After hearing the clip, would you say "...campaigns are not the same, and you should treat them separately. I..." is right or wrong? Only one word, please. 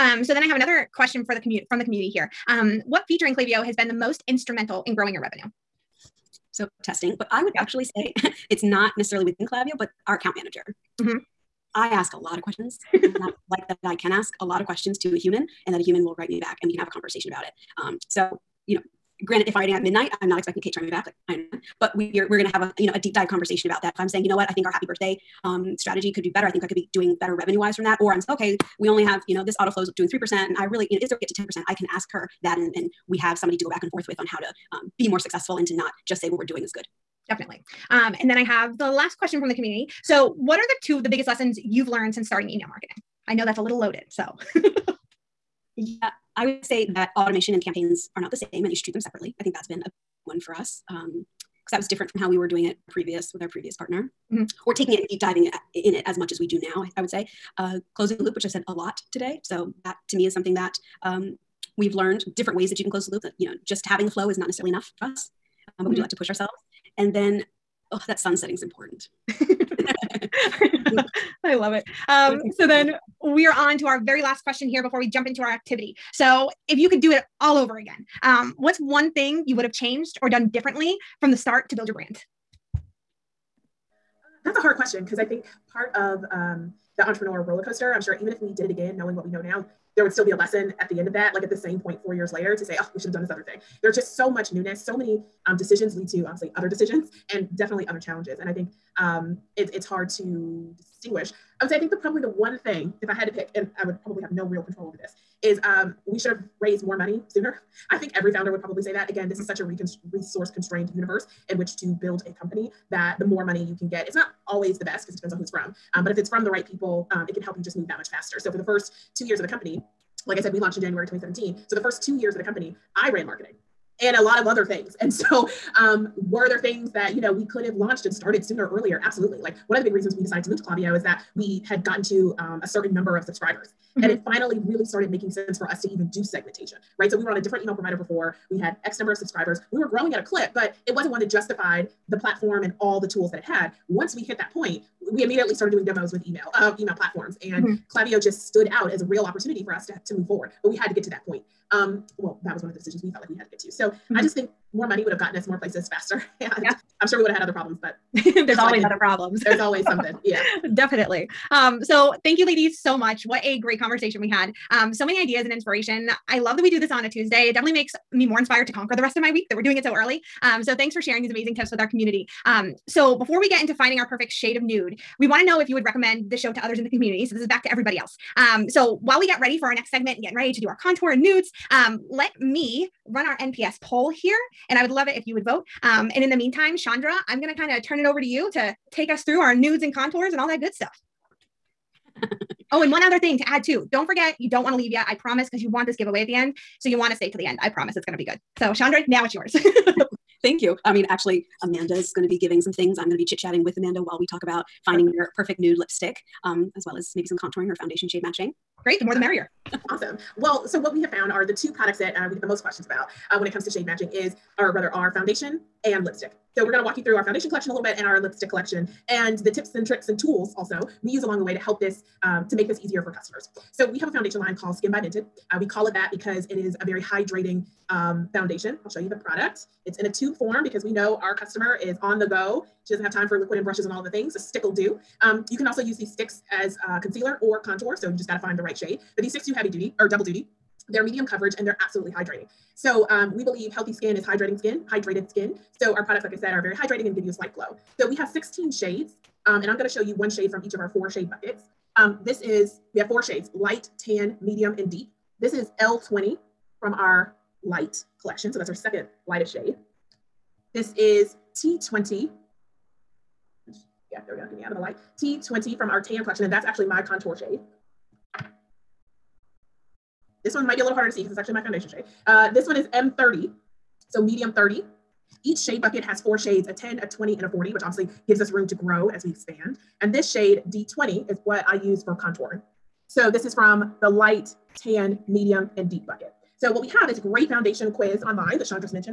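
right.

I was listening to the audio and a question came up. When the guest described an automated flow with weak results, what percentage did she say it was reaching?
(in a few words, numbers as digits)
3%.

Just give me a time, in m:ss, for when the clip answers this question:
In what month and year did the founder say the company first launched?
2:00.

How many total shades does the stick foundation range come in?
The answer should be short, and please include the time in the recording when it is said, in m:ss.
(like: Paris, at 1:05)
16, at 4:08.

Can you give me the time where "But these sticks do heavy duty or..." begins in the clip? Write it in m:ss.
3:59.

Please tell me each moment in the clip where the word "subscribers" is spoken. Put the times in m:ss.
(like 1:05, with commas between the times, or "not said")
2:13, 2:19.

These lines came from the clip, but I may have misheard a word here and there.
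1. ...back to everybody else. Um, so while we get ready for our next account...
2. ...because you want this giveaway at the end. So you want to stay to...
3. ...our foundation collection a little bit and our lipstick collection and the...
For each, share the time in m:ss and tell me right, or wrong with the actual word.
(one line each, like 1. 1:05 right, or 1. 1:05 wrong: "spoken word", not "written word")
1. 2:57 wrong: "segment", not "account"
2. 3:15 right
3. 3:37 right.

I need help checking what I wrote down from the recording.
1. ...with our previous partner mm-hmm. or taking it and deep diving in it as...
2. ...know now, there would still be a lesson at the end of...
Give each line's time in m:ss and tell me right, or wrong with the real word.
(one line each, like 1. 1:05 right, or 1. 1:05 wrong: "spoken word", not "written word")
1. 0:53 right
2. 1:29 right.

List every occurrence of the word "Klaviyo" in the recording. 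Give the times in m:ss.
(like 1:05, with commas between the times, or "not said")
0:03, 0:09, 2:10, 2:27.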